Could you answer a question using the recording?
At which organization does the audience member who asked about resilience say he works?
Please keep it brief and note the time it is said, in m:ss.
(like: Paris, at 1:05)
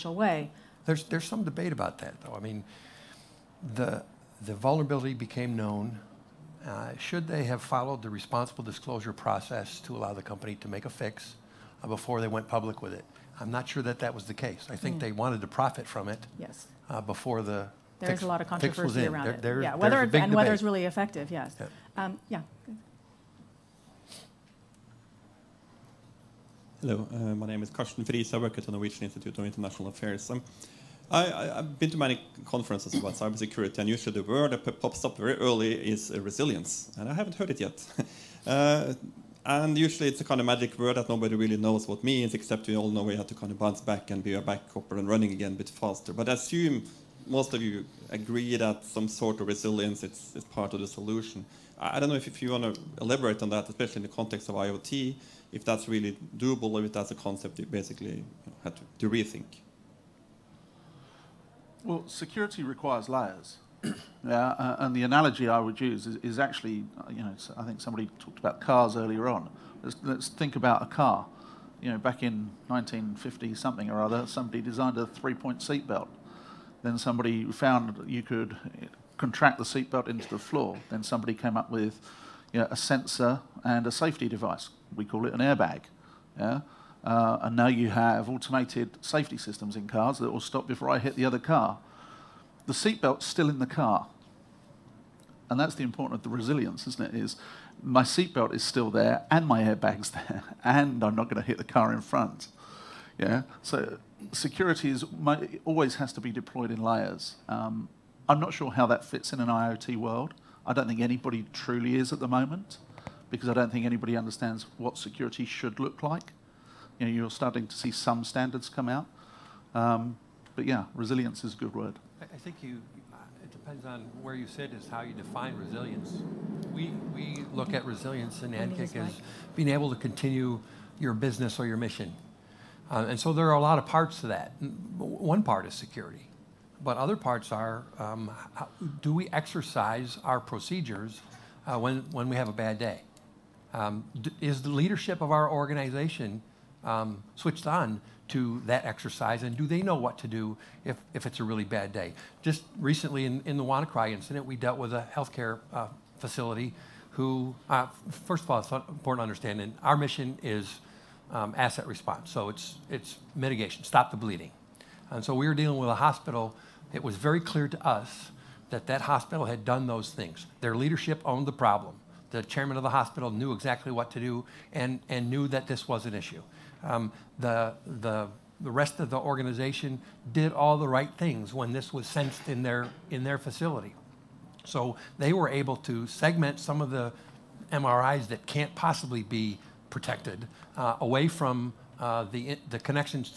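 Norwegian Institute of International Affairs, at 0:28.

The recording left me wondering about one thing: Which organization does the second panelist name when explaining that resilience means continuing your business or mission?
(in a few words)
NCCIC.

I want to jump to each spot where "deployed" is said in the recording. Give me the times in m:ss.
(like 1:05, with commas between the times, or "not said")
1:46.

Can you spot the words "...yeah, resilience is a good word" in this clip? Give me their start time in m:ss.
2:00.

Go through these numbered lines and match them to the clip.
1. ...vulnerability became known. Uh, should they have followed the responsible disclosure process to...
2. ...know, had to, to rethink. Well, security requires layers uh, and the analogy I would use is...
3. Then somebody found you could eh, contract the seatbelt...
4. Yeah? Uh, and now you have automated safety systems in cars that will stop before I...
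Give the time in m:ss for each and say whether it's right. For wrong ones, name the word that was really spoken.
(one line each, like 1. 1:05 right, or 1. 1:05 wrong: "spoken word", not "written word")
1. 0:04 right
2. 0:58 right
3. 1:16 right
4. 1:26 right.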